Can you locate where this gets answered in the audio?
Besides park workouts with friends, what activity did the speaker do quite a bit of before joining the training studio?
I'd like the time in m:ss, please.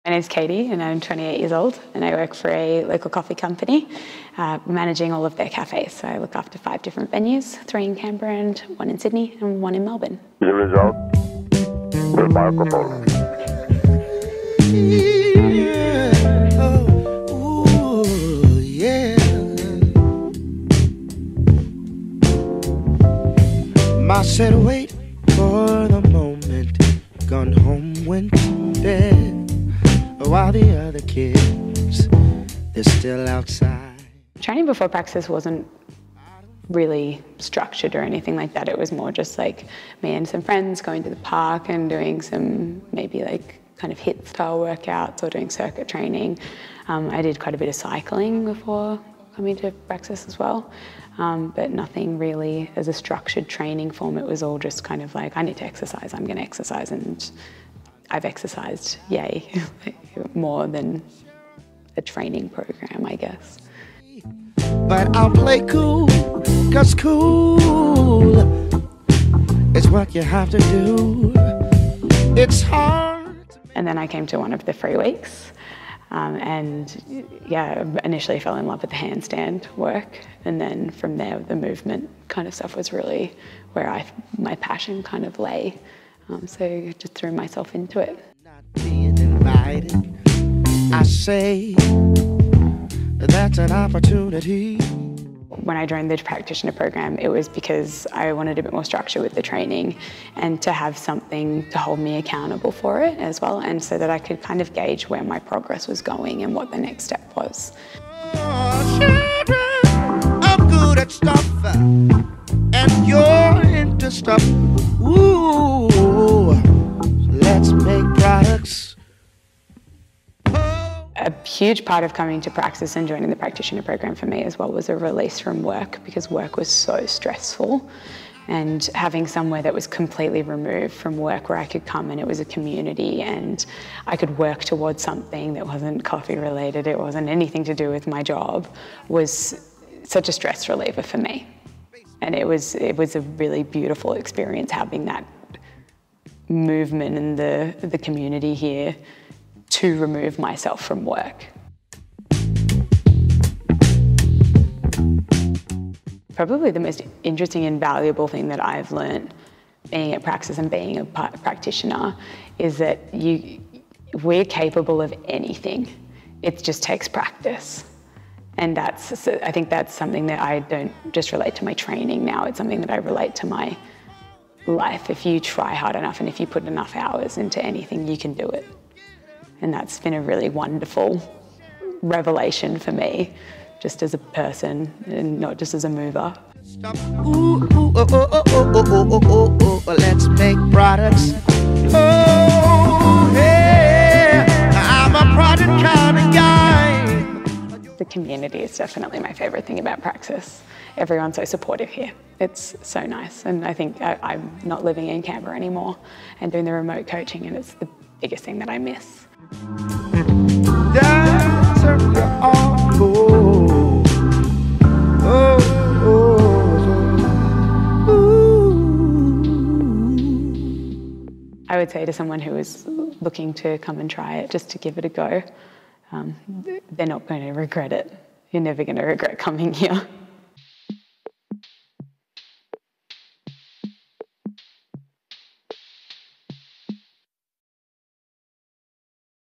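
0:47.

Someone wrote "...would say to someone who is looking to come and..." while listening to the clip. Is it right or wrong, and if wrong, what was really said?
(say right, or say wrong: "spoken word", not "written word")
right.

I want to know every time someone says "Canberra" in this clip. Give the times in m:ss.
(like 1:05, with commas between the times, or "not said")
0:07, 3:25.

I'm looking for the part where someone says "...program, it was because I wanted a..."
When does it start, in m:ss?
1:36.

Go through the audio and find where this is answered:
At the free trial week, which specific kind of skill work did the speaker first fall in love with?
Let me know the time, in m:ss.
1:18.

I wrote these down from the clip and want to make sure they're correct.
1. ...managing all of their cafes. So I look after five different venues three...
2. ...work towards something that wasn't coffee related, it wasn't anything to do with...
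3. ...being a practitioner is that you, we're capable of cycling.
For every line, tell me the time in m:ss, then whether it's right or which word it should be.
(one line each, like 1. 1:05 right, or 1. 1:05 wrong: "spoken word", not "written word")
1. 0:04 right
2. 2:14 right
3. 2:40 wrong: "anything", not "cycling".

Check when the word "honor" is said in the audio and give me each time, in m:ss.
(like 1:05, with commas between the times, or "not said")
not said.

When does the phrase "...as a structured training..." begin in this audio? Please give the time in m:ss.
0:52.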